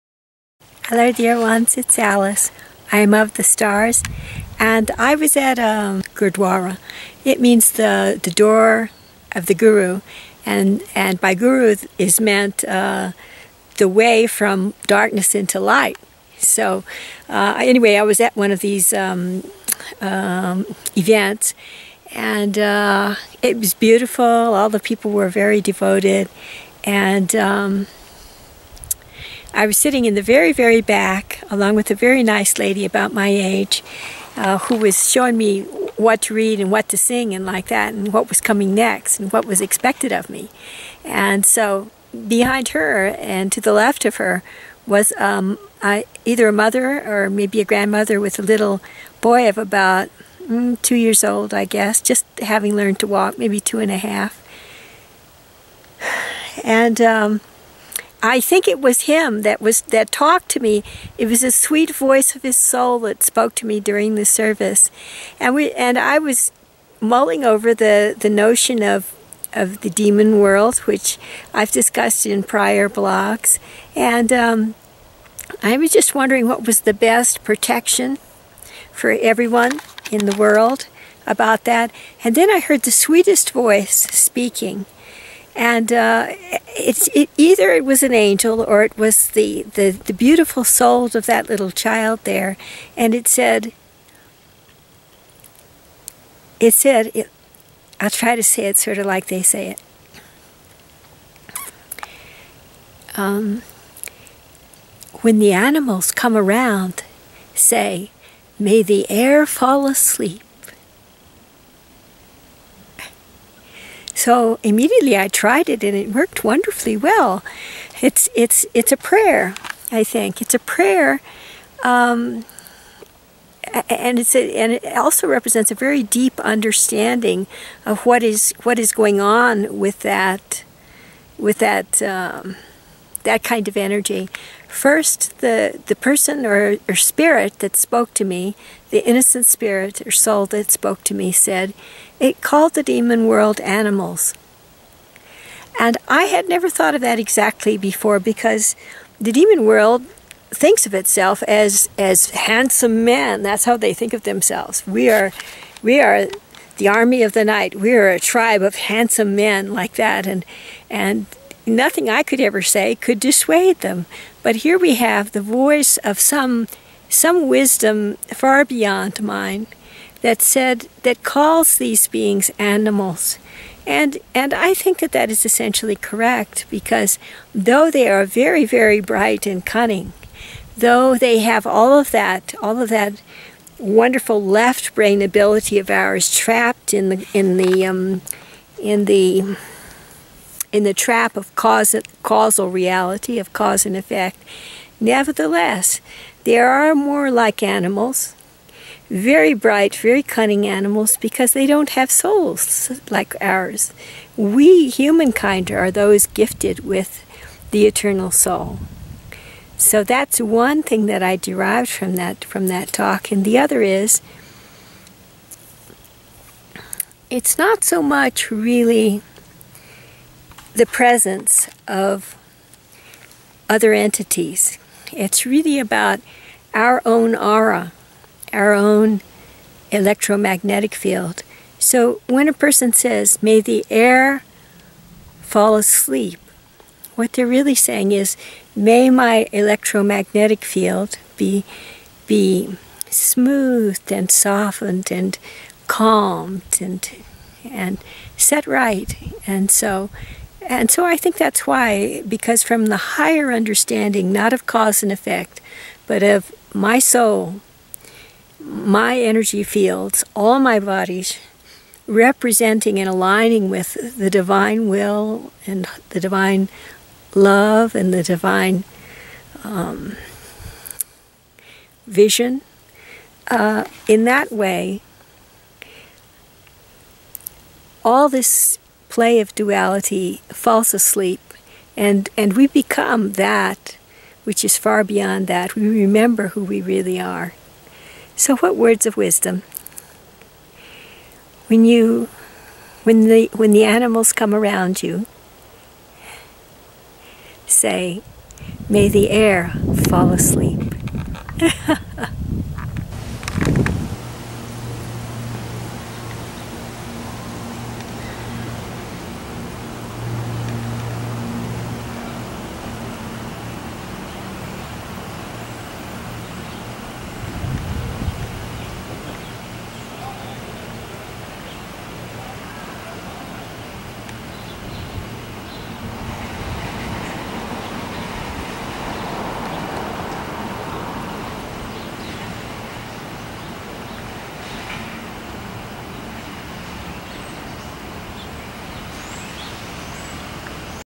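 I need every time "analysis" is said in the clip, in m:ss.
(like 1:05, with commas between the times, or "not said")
not said.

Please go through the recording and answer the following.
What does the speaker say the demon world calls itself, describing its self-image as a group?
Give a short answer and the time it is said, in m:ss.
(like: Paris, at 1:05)
army of the night, at 2:36.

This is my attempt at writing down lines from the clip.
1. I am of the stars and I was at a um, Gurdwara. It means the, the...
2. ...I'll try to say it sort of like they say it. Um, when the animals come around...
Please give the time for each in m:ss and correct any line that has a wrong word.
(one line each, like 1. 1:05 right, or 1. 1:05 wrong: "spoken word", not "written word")
1. 0:02 right
2. 1:37 right.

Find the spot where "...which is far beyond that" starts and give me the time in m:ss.
4:44.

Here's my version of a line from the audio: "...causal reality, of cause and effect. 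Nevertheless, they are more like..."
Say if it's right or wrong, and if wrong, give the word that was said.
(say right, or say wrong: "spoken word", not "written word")
right.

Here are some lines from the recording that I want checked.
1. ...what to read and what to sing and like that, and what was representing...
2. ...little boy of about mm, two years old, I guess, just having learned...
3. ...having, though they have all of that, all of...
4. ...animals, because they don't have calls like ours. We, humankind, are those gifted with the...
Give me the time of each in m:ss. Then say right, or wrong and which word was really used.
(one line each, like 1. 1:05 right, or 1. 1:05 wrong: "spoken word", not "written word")
1. 0:35 wrong: "coming", not "representing"
2. 0:48 right
3. 2:59 wrong: "cunning", not "having"
4. 3:20 wrong: "souls", not "calls".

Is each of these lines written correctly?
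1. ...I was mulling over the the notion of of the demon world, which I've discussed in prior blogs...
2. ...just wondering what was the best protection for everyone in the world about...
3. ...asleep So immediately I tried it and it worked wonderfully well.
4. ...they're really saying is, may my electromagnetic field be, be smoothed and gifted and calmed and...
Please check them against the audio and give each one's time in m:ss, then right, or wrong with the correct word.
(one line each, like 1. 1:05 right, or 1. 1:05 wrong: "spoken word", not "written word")
1. 1:05 right
2. 1:15 right
3. 1:49 right
4. 3:57 wrong: "softened", not "gifted".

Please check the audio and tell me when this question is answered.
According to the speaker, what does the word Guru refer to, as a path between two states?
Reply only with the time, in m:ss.
0:13.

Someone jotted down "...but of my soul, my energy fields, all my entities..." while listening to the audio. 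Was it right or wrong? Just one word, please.
wrong.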